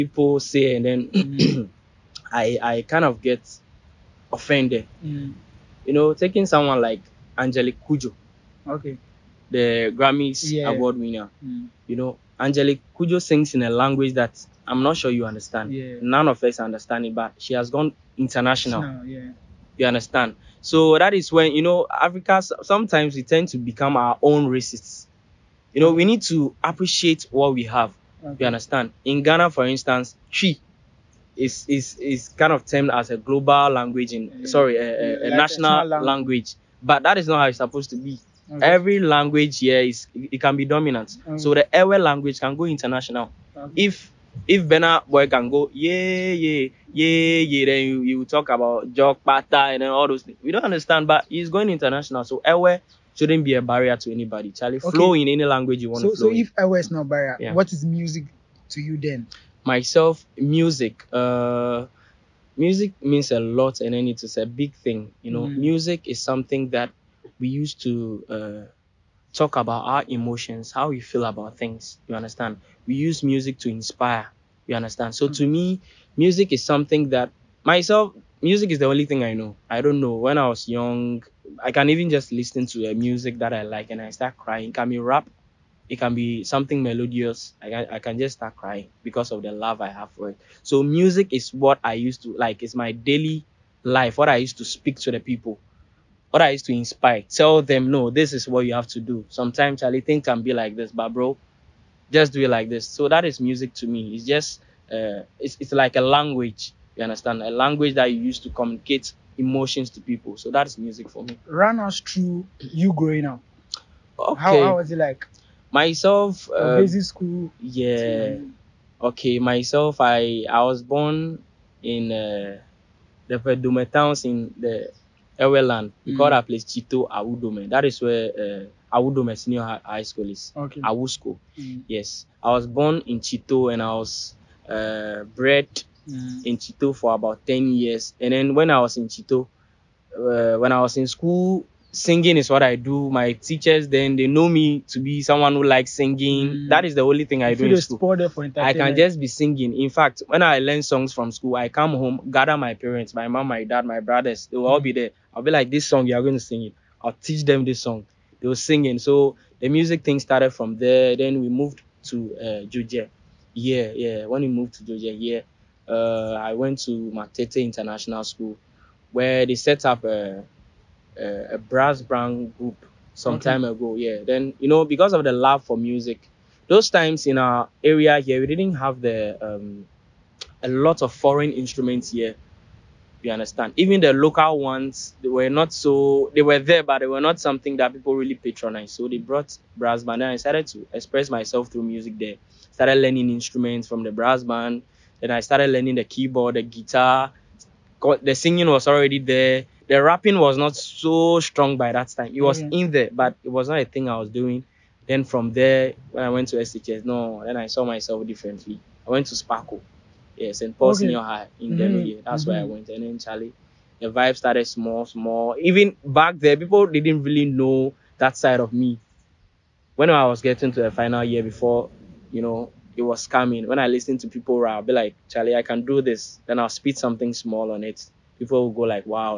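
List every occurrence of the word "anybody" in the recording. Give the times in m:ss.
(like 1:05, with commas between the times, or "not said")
0:54.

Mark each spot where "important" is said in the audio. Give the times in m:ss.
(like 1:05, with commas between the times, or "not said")
not said.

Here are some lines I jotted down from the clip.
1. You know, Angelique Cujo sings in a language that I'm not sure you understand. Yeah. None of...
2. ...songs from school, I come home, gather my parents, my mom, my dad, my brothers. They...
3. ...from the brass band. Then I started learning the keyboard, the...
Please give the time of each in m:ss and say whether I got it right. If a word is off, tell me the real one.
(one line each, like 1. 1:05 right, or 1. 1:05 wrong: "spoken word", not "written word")
1. 0:11 right
2. 2:30 right
3. 3:13 right.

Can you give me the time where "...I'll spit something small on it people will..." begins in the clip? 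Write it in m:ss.
3:46.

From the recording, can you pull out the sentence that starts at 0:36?
language, but that is not how it's supposed to be.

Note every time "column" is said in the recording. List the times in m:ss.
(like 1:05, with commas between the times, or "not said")
not said.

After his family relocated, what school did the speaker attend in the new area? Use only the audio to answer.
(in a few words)
Matete International School.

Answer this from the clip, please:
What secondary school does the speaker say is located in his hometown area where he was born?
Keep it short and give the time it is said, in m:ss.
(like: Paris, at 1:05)
Awudome Senior High School, at 2:08.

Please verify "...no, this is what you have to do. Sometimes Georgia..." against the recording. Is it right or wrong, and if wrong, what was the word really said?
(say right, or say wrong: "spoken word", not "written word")
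wrong: "Charlie", not "Georgia".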